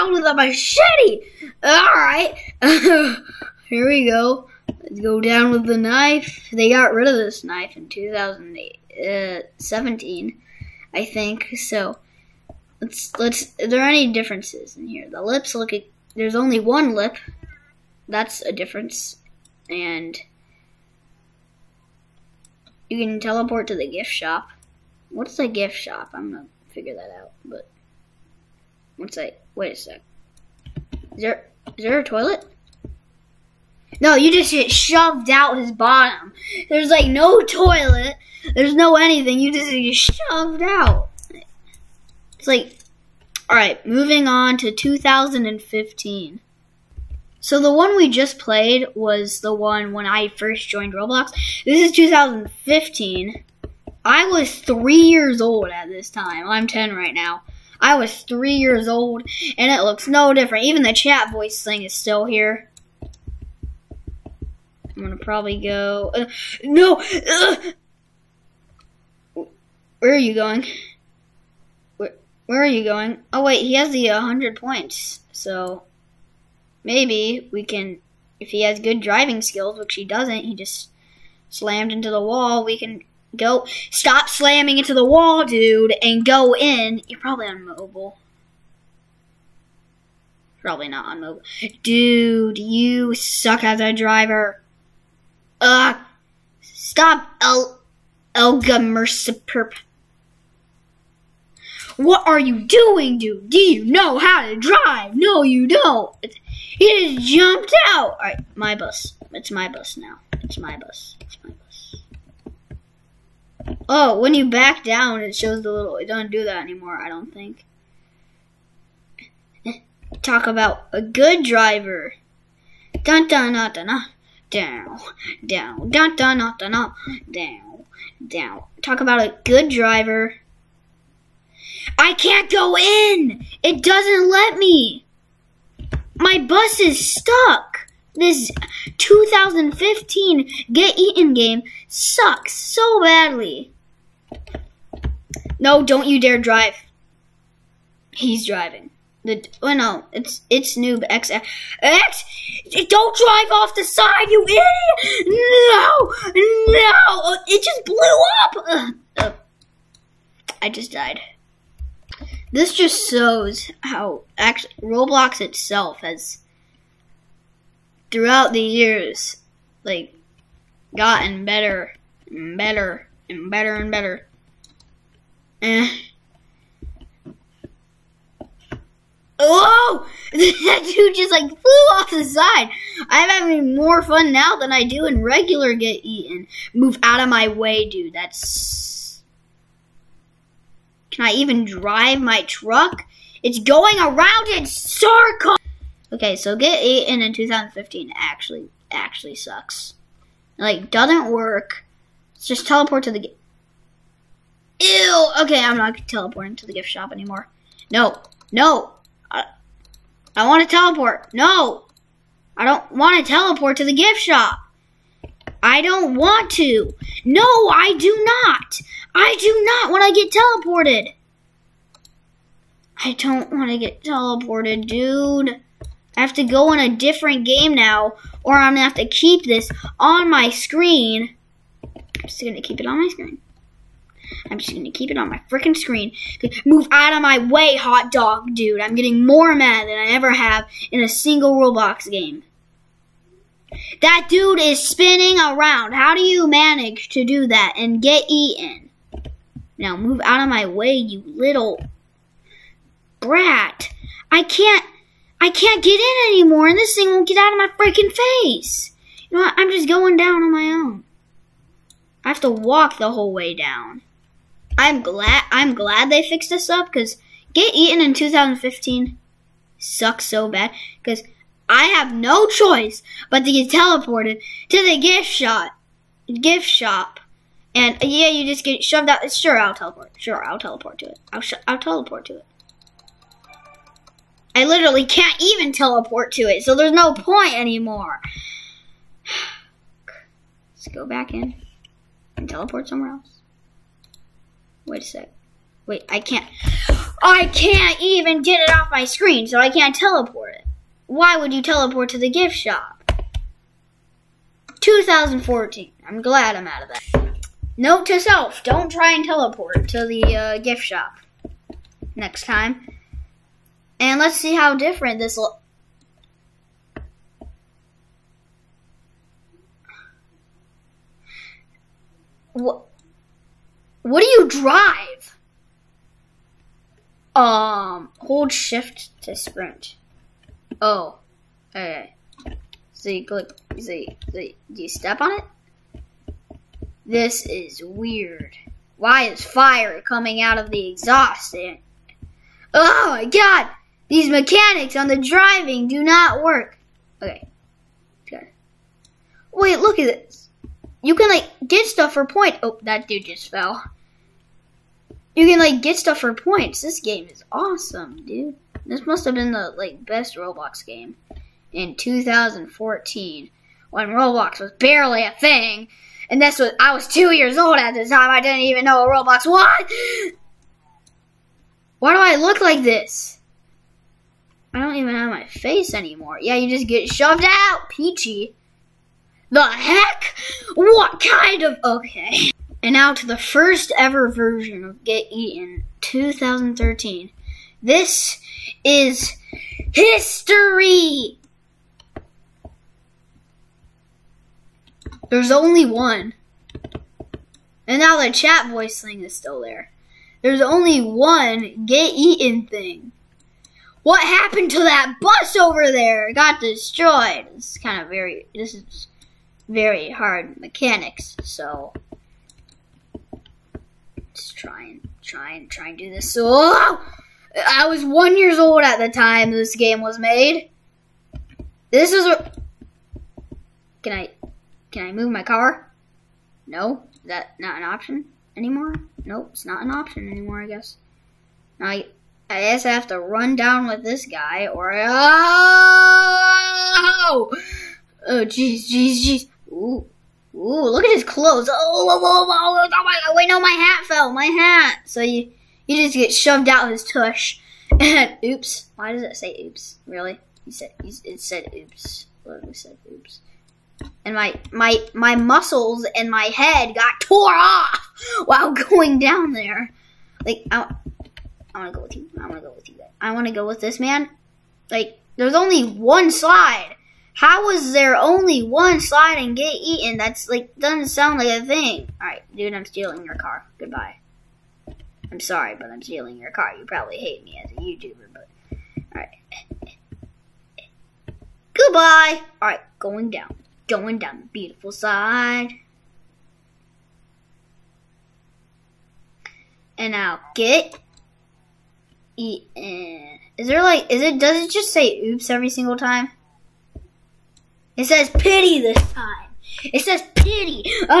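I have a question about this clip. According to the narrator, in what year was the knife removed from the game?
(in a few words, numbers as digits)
2008.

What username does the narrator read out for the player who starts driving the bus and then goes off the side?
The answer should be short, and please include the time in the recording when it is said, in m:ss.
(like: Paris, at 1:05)
noob X X, at 2:30.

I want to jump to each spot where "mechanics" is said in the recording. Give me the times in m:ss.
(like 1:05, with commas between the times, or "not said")
5:44, 6:50.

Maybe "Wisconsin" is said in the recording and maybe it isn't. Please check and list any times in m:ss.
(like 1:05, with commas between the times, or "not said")
not said.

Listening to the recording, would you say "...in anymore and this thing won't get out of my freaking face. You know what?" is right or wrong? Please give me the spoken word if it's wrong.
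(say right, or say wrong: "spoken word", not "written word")
right.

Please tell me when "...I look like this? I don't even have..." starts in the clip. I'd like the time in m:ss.
6:12.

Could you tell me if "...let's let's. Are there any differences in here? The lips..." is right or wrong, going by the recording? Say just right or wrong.
right.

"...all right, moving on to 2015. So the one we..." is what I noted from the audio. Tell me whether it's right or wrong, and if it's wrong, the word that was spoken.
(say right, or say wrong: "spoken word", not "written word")
right.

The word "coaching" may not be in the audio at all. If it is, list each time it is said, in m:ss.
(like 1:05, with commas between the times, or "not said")
not said.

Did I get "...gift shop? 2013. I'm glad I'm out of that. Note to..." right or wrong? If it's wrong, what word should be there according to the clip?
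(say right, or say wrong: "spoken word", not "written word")
wrong: "2014", not "2013".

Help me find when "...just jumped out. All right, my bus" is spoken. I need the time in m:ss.
1:47.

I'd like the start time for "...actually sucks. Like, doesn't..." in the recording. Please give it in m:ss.
3:18.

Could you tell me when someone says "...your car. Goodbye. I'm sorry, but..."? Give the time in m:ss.
7:53.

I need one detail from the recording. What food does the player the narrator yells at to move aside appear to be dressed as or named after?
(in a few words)
Hot dog.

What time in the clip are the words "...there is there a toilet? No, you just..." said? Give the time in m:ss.
0:31.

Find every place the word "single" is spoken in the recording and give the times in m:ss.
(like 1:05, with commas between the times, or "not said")
4:01, 8:15.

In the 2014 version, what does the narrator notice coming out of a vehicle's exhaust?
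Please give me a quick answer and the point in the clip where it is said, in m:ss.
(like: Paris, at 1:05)
Fire, at 5:39.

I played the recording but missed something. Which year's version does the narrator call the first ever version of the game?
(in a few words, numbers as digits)
2013.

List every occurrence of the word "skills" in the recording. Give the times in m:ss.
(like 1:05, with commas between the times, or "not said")
1:19.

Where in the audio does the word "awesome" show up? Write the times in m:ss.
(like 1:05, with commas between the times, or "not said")
5:57.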